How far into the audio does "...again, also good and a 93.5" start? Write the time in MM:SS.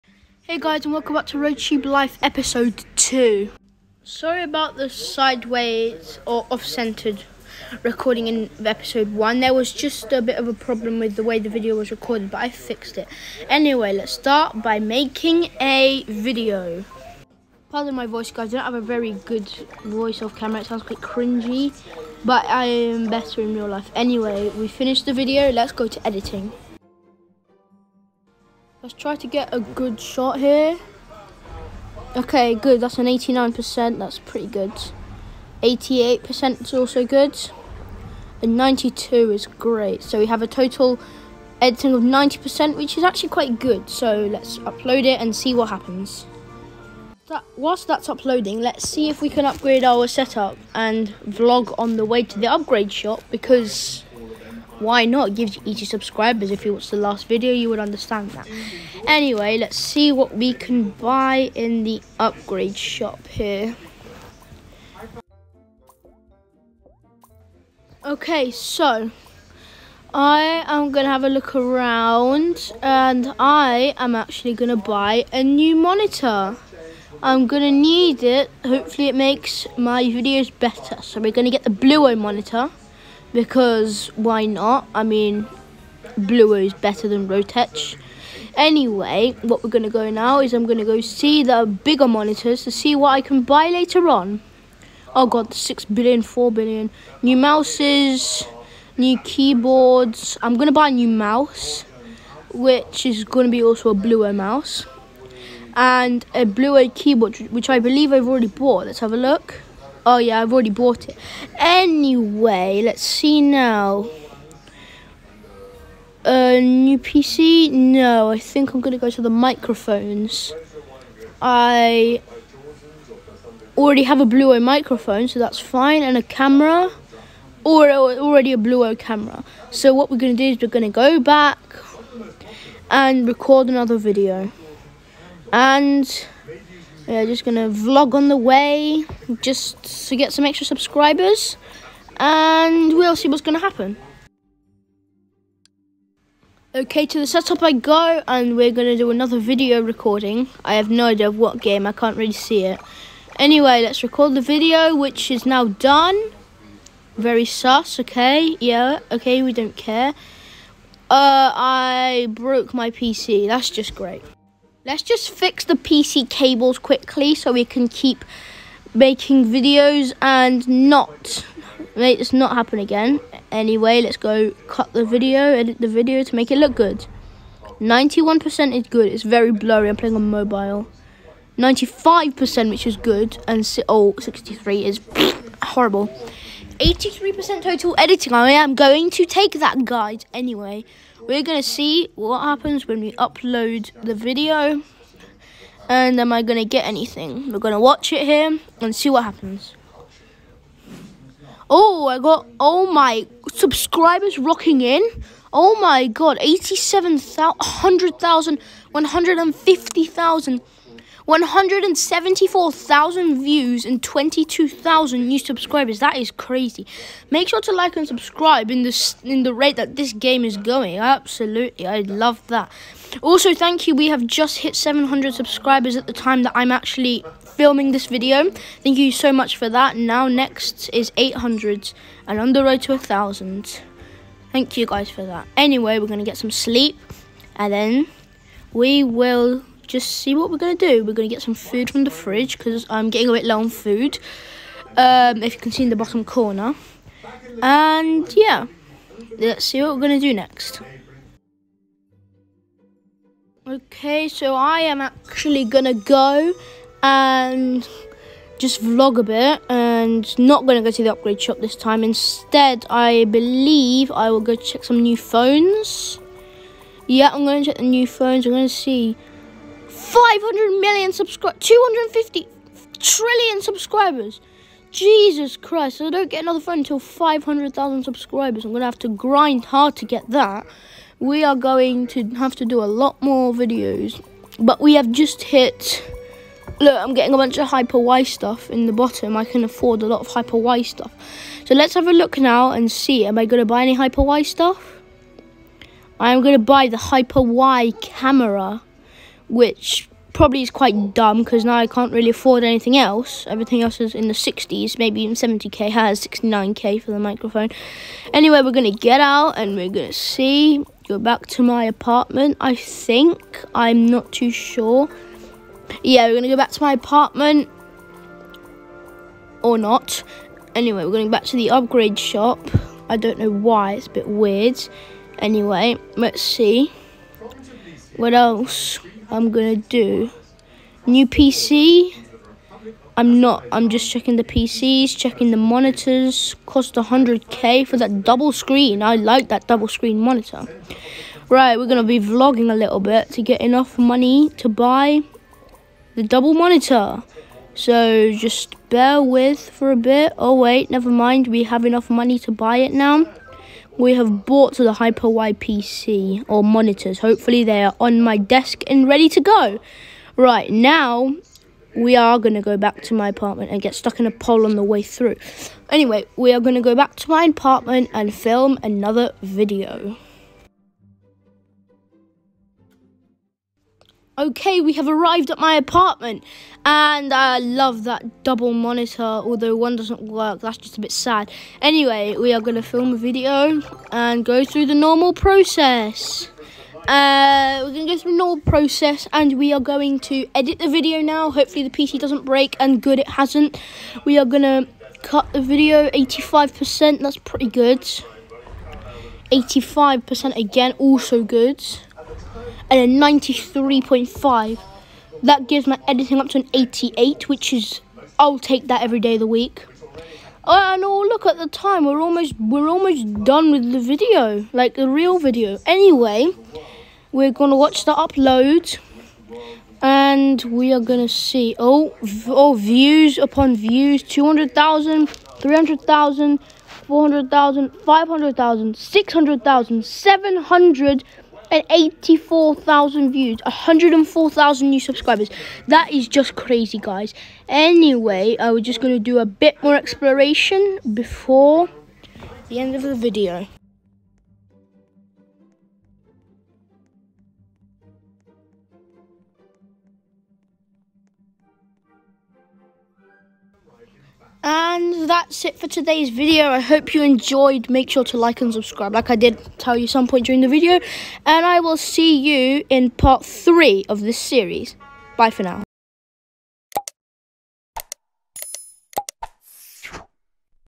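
06:40.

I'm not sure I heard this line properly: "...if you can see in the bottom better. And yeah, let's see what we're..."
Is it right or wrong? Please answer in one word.
wrong.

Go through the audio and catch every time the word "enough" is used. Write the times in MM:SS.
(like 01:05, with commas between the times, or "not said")
05:43, 05:51.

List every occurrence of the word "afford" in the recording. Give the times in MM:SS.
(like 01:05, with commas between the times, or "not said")
04:49, 05:02.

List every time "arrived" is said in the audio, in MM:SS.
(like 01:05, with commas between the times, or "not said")
06:15.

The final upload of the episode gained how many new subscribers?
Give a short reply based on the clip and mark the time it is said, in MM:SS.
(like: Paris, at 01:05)
104,000, at 07:13.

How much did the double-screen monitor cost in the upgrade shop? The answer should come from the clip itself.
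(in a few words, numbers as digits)
100k.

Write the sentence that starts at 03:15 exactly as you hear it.
And am I going to get anything?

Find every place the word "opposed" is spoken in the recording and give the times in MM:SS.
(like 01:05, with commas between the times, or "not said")
not said.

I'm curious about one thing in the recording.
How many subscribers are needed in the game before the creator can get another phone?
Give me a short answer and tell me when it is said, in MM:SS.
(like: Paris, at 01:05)
500,000, at 04:36.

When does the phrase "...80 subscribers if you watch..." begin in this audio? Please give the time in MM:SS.
00:55.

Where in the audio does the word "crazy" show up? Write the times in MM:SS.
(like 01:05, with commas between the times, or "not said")
03:36, 07:16.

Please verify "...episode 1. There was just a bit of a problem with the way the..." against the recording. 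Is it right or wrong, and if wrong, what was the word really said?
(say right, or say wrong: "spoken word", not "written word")
right.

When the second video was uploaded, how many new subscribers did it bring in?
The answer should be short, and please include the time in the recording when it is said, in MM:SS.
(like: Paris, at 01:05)
22,000, at 03:34.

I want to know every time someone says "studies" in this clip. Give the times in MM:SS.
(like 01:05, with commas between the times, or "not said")
not said.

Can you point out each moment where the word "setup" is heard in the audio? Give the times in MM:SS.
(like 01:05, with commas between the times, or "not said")
00:50, 02:27.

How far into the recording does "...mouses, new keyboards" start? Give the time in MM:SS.
01:37.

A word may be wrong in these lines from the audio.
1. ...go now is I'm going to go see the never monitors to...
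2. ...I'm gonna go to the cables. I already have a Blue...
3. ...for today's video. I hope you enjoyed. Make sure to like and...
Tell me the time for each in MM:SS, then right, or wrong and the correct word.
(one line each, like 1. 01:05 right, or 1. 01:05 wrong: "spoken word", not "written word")
1. 01:29 wrong: "bigger", not "never"
2. 01:58 wrong: "microphones", not "cables"
3. 07:35 right.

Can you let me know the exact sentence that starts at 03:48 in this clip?
Thank you so much for that.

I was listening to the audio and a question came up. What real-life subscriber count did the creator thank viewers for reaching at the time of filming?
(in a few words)
700.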